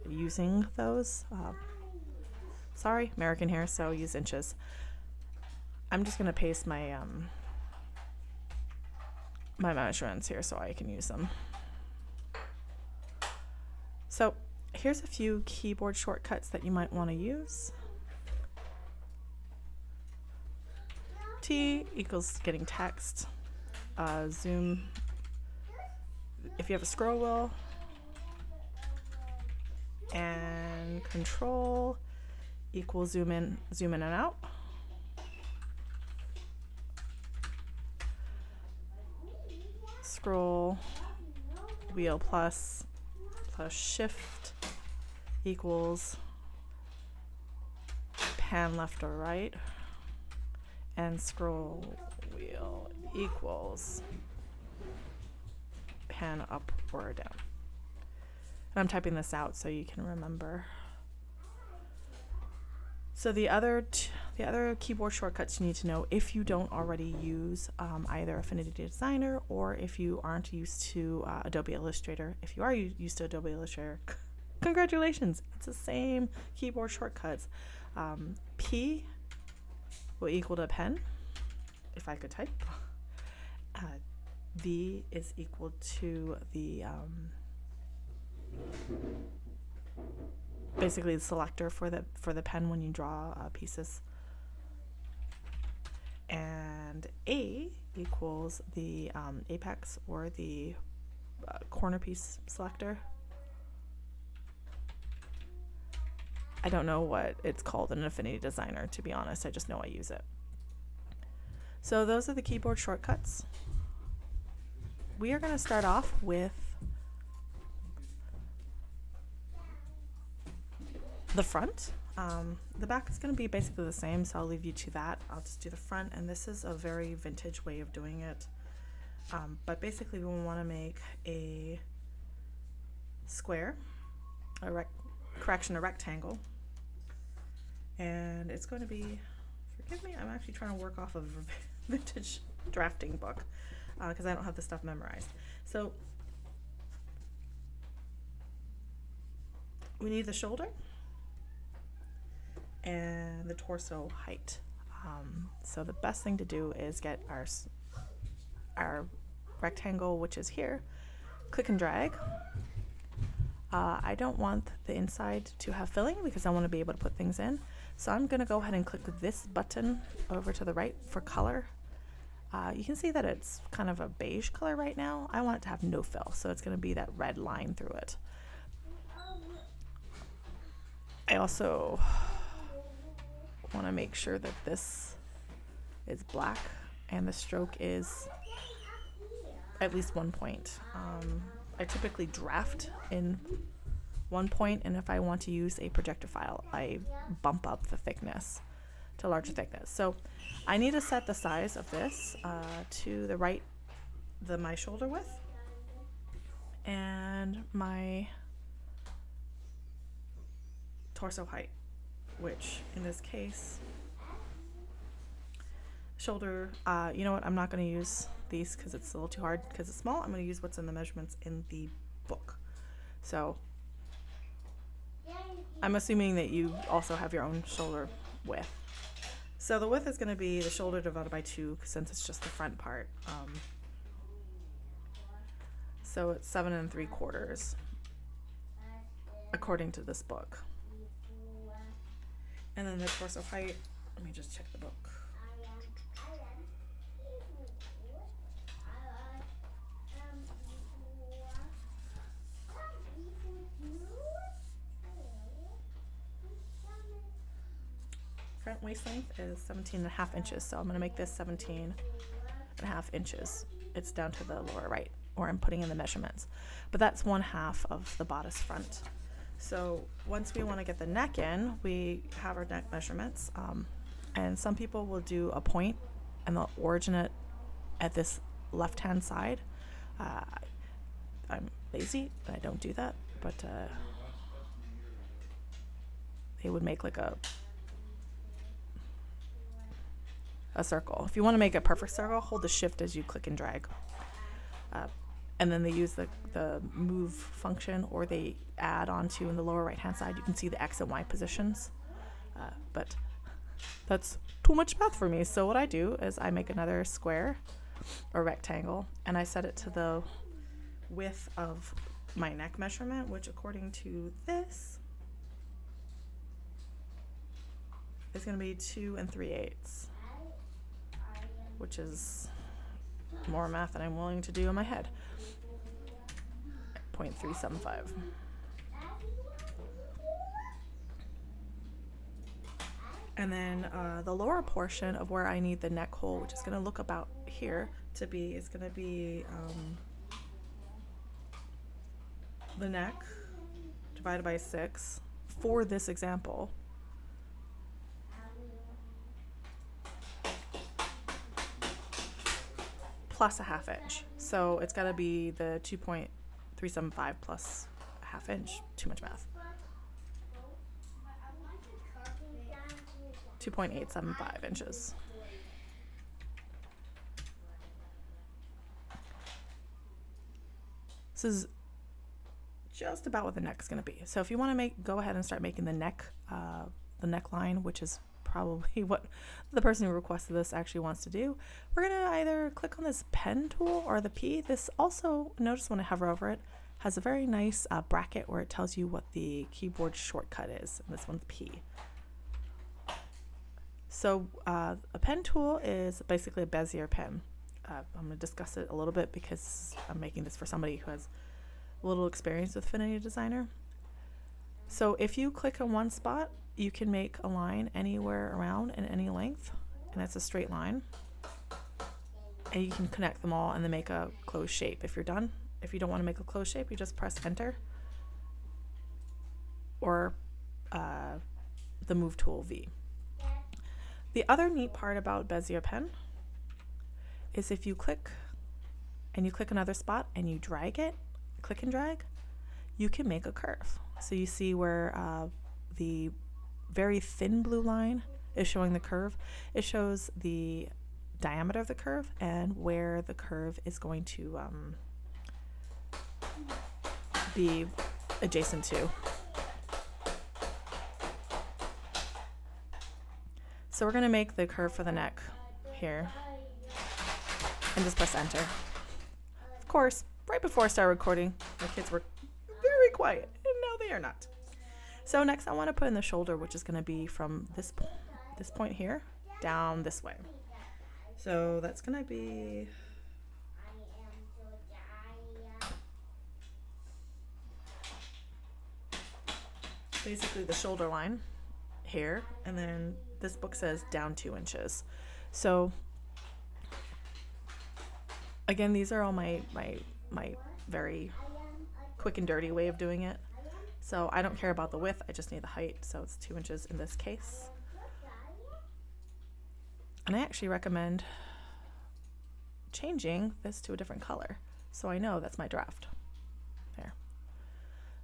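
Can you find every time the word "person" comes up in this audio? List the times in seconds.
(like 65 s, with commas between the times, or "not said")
379 s.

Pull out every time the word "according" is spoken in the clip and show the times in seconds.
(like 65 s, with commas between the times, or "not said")
239 s, 313 s.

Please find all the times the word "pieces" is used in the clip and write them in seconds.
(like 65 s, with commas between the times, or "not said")
93 s, 101 s.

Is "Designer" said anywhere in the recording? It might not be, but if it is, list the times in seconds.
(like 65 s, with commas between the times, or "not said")
68 s, 108 s, 403 s.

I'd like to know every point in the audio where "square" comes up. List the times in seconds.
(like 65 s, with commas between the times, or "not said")
133 s, 307 s.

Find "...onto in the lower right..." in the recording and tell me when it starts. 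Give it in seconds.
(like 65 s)
299 s.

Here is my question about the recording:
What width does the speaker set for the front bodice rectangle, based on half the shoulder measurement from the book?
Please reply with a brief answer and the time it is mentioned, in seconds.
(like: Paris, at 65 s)
7 and 3 quarters, at 236 s.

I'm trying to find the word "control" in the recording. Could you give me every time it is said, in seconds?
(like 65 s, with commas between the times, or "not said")
31 s.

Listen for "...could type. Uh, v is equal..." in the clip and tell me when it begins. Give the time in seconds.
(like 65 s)
82 s.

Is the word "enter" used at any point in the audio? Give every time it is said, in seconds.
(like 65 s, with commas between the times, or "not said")
417 s, 458 s.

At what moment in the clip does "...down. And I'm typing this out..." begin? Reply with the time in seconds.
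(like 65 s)
57 s.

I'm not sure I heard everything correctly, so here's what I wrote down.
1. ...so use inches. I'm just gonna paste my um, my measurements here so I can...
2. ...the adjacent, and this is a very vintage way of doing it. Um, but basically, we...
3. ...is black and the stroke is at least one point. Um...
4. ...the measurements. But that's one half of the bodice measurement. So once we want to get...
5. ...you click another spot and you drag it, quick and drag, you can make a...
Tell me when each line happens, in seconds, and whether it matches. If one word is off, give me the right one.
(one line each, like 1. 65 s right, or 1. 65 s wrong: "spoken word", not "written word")
1. 3 s right
2. 125 s wrong: "front", not "adjacent"
3. 186 s right
4. 265 s wrong: "front", not "measurement"
5. 429 s wrong: "click", not "quick".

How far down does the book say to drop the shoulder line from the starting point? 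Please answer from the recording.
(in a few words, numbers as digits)
2 inches.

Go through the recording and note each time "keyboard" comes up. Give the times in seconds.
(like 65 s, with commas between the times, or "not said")
15 s, 64 s, 76 s, 112 s, 389 s.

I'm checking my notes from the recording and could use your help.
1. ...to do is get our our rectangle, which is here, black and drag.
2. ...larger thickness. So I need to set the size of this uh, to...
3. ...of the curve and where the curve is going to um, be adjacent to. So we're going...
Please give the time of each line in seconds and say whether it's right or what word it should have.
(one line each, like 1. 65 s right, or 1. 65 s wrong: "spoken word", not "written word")
1. 156 s wrong: "click", not "black"
2. 199 s right
3. 441 s right.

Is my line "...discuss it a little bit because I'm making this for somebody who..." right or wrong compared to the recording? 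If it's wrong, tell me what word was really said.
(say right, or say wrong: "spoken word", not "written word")
right.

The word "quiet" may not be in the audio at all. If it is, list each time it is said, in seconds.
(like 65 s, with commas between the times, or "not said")
463 s.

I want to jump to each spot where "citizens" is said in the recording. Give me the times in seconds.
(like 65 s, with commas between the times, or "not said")
not said.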